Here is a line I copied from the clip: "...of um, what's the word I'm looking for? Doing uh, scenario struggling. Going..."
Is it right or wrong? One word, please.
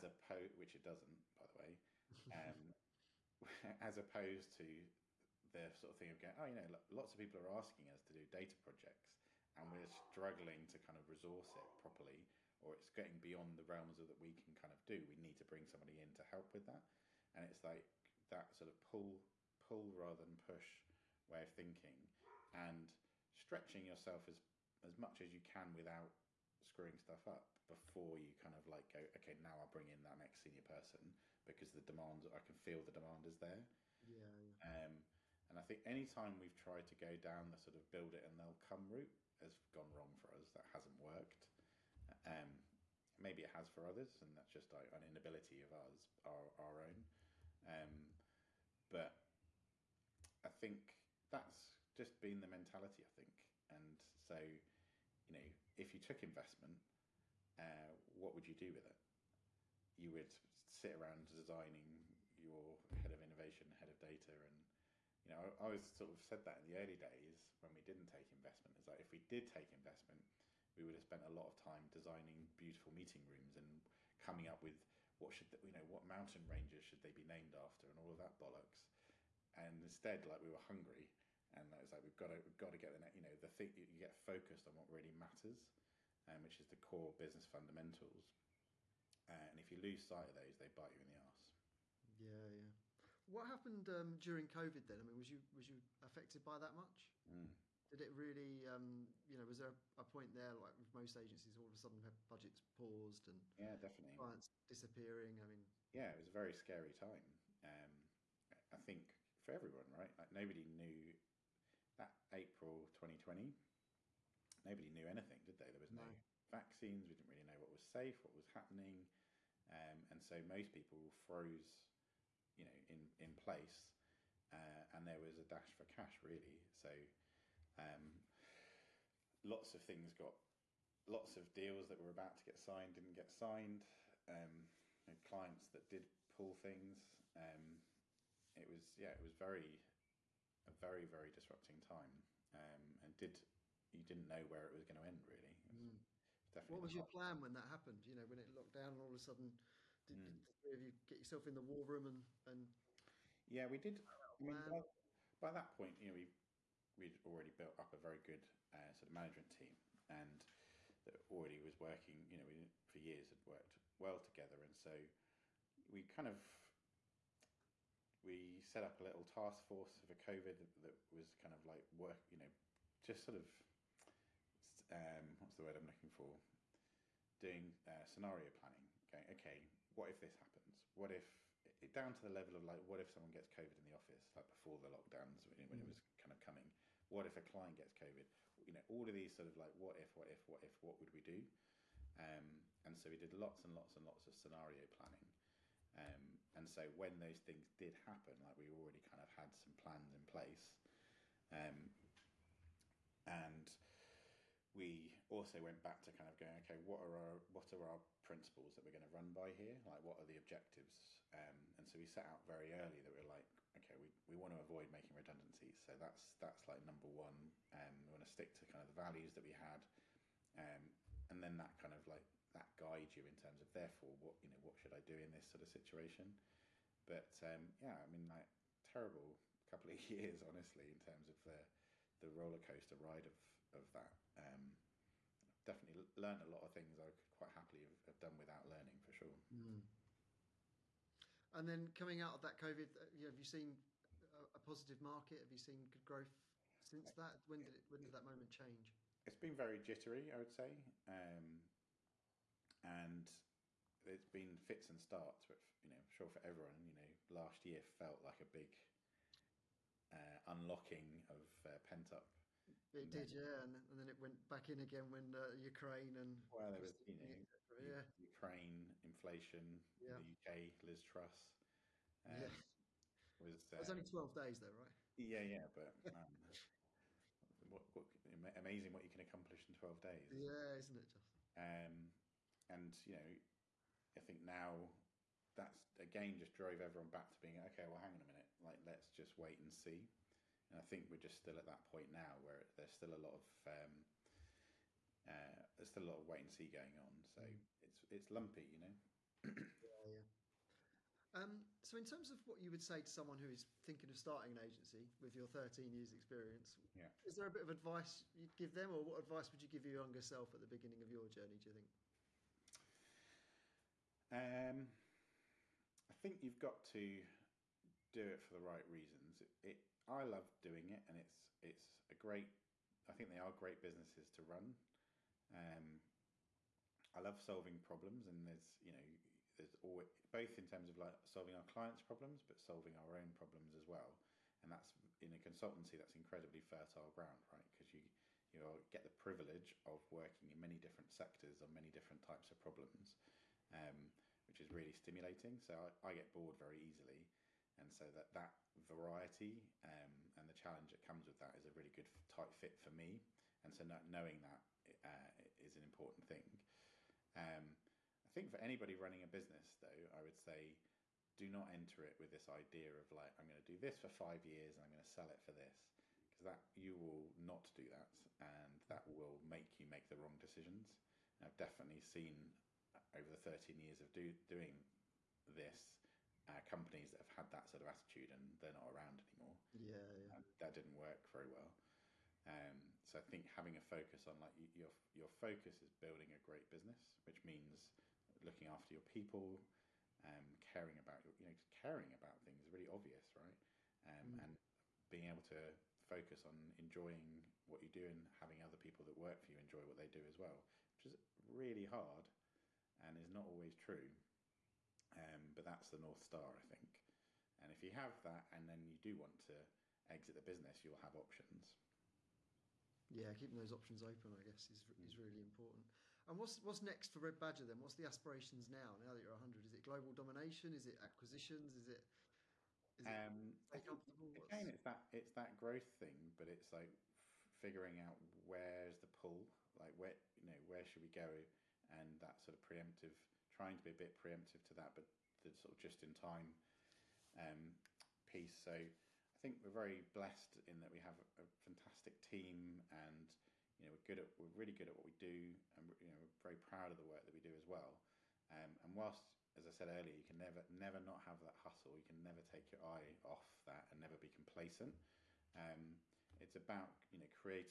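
wrong.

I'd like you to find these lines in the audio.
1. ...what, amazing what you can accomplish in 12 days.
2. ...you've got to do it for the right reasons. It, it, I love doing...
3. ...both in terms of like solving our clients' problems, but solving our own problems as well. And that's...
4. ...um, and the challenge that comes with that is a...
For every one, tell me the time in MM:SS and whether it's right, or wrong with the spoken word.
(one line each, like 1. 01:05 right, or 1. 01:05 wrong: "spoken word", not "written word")
1. 04:37 right
2. 05:16 right
3. 05:30 right
4. 05:49 right.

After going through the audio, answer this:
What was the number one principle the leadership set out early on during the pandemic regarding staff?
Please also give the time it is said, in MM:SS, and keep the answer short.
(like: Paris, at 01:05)
Avoid making redundancies, at 03:34.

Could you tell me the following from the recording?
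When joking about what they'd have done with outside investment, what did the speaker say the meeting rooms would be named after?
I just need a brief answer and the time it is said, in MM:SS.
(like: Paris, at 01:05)
Mountain ranges, at 01:16.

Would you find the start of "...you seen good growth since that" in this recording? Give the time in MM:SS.
04:05.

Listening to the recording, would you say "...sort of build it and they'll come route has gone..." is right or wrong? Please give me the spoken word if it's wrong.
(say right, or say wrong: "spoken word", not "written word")
right.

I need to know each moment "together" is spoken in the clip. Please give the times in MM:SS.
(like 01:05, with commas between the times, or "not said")
02:44.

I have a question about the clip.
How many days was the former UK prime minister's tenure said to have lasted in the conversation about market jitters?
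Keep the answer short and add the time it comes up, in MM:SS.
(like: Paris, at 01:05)
12, at 04:34.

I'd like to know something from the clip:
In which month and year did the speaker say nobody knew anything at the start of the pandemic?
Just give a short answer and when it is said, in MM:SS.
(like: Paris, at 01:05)
April 2020, at 01:52.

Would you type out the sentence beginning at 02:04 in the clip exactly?
Uh, and there was a dash for cash, really.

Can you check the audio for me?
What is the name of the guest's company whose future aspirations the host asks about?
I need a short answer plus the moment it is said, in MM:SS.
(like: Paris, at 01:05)
Red Badger, at 06:57.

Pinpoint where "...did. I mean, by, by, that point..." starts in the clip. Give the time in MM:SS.
02:33.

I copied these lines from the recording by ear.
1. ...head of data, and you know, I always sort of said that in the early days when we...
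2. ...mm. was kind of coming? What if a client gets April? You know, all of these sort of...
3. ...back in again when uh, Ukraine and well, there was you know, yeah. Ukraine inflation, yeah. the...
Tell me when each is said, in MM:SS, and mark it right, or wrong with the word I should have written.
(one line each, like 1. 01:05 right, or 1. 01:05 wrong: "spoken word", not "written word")
1. 01:03 right
2. 03:05 wrong: "COVID", not "April"
3. 04:24 right.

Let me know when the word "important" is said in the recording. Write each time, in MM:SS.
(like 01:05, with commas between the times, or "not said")
05:55, 06:55.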